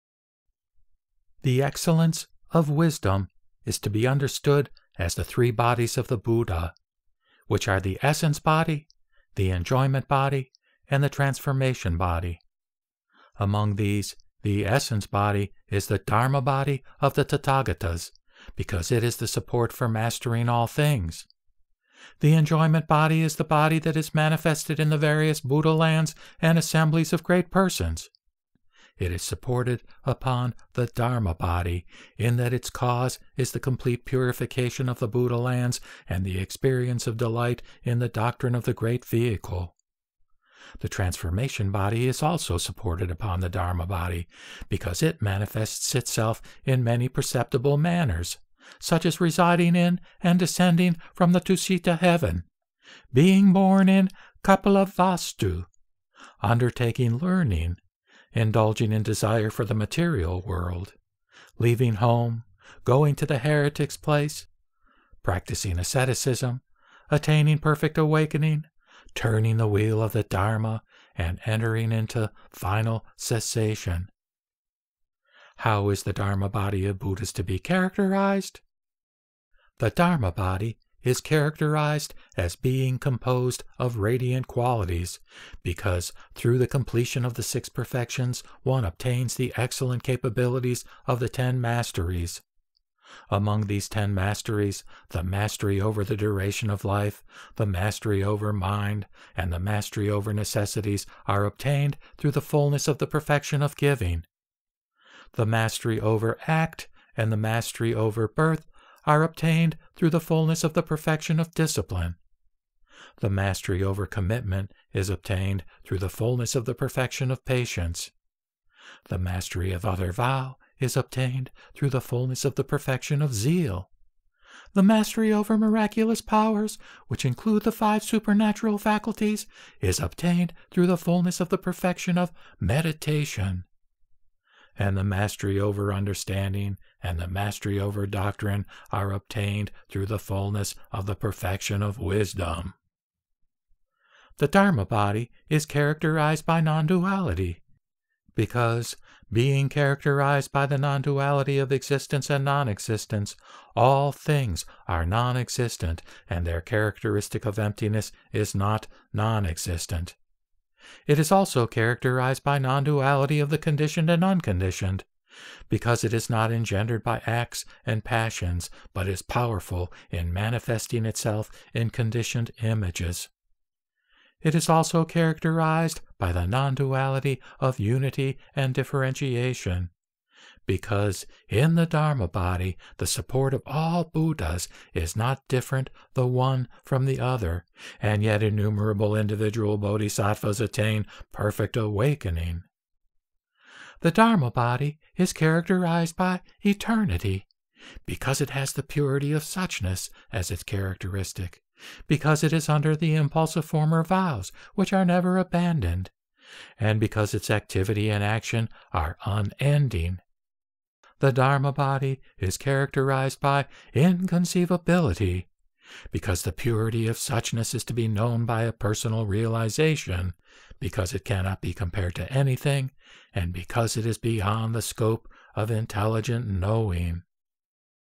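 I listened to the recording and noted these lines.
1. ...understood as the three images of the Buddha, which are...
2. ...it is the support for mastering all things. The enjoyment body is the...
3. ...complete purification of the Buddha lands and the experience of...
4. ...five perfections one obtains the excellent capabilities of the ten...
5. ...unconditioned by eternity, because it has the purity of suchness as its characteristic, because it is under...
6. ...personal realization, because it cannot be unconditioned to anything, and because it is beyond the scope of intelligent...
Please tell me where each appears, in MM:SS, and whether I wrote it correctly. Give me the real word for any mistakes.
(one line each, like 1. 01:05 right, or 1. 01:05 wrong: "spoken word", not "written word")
1. 00:04 wrong: "bodies", not "images"
2. 00:18 right
3. 00:33 right
4. 01:27 wrong: "six", not "five"
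5. 03:15 wrong: "characterized", not "unconditioned"
6. 03:38 wrong: "compared", not "unconditioned".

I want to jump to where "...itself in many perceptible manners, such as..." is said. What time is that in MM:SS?
00:45.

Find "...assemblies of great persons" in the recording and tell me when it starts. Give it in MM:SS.
00:26.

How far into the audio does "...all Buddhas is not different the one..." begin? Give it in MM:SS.
03:03.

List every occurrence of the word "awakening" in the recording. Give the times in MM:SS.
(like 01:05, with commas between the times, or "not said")
01:07, 03:11.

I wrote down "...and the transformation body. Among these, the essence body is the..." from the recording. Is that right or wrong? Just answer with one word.
right.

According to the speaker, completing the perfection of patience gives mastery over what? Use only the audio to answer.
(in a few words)
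commitment.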